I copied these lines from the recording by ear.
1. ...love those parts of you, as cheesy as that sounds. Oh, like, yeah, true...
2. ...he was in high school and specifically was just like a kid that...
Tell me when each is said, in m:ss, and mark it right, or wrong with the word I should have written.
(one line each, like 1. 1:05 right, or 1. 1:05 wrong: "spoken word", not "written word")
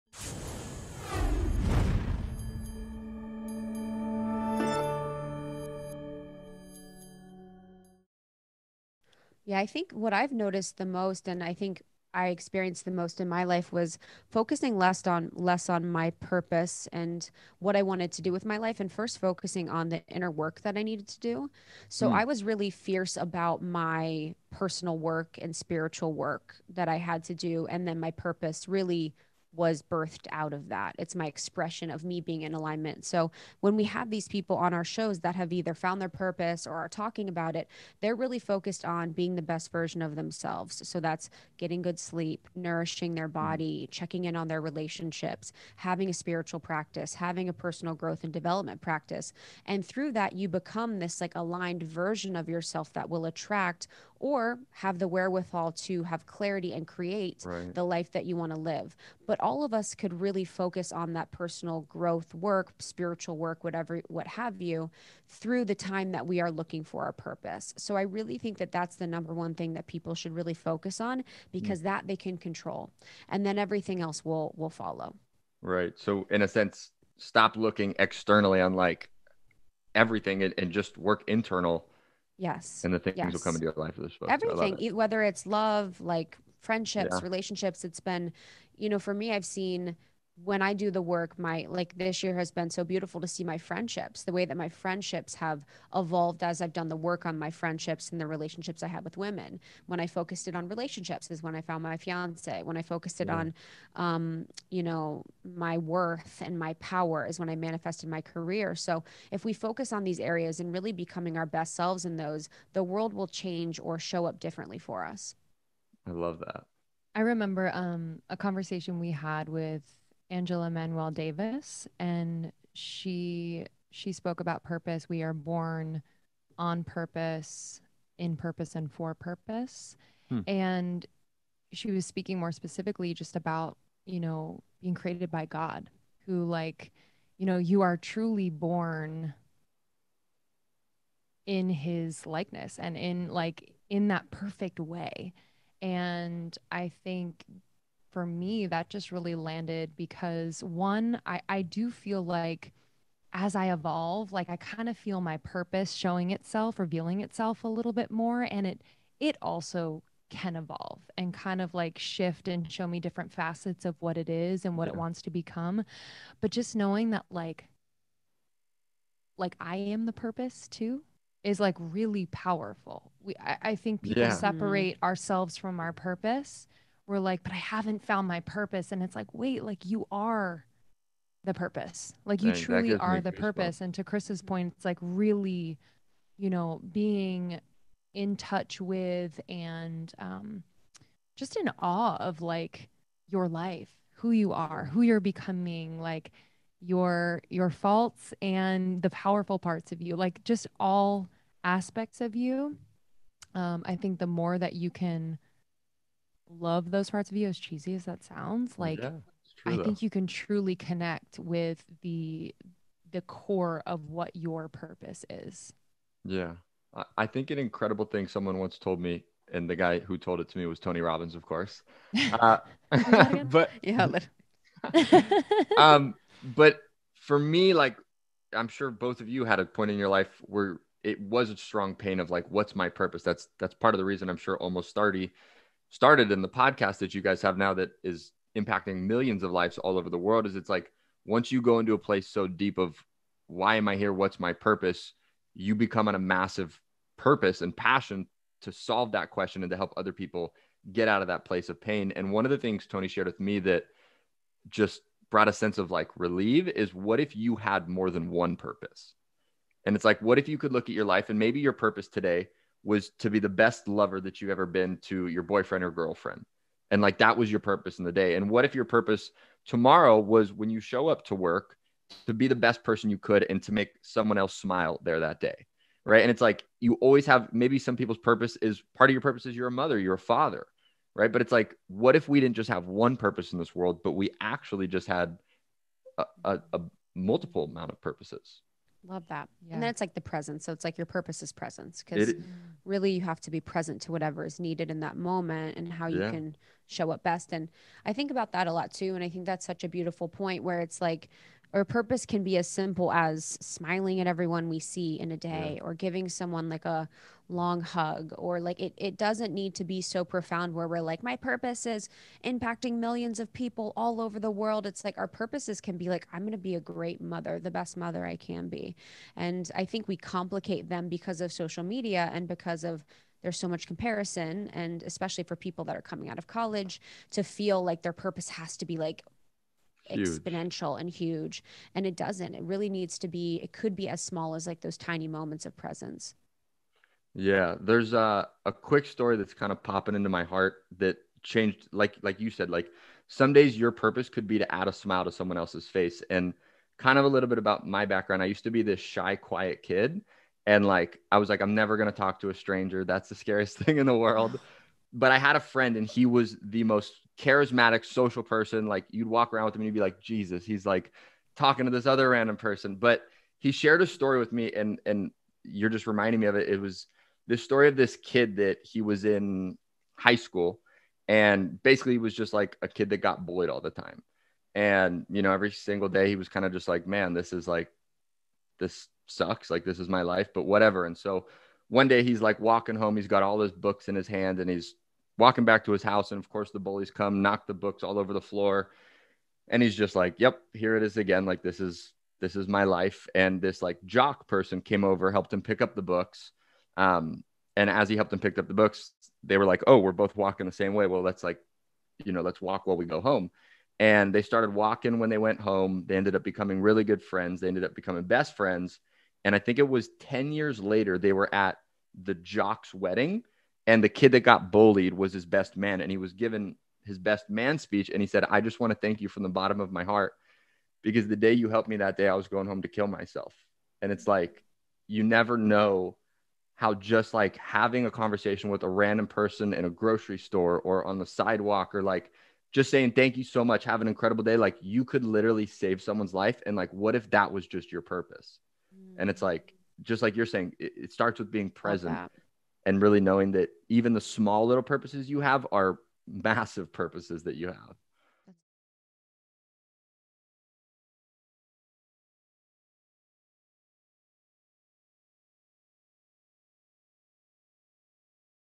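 1. 3:26 right
2. 6:08 wrong: "basically", not "specifically".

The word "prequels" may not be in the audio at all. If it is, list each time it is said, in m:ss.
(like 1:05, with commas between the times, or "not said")
not said.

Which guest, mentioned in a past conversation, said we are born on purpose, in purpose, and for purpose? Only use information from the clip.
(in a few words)
Angela Manuel Davis.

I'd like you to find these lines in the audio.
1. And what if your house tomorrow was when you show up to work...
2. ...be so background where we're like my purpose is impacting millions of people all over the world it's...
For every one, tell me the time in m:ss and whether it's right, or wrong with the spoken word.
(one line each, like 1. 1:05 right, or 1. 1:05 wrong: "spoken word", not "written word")
1. 4:28 wrong: "purpose", not "house"
2. 5:09 wrong: "profound", not "background".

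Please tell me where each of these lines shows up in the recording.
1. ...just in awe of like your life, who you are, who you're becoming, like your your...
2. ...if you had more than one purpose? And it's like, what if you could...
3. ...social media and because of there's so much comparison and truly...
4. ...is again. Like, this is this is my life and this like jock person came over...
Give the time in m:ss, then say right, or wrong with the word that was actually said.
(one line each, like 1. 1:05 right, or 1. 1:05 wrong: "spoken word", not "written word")
1. 3:11 right
2. 4:17 right
3. 5:21 wrong: "especially", not "truly"
4. 6:31 right.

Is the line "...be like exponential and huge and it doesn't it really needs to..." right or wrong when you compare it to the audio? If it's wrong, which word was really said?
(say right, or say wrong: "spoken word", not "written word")
right.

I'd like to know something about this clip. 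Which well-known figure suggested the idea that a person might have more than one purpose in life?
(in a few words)
Tony Robbins.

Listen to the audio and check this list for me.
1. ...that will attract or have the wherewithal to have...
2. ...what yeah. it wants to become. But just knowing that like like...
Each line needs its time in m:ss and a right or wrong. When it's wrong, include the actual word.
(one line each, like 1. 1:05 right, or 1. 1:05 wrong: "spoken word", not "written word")
1. 0:52 right
2. 2:44 right.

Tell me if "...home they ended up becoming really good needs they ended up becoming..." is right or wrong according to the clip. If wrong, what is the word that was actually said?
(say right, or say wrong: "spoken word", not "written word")
wrong: "friends", not "needs".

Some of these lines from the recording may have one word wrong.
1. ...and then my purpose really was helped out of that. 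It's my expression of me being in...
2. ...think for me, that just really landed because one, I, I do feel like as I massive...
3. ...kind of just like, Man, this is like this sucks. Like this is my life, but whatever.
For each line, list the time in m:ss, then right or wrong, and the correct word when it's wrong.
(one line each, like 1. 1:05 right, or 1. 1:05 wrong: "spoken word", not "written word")
1. 0:27 wrong: "birthed", not "helped"
2. 2:27 wrong: "evolve", not "massive"
3. 6:16 right.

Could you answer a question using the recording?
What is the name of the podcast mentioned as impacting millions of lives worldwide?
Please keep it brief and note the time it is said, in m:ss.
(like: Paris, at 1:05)
Almost 30, at 3:54.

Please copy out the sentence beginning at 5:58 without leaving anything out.
Like you'd walk around with him and you'd be like, Jesus, he's like talking to this other random person.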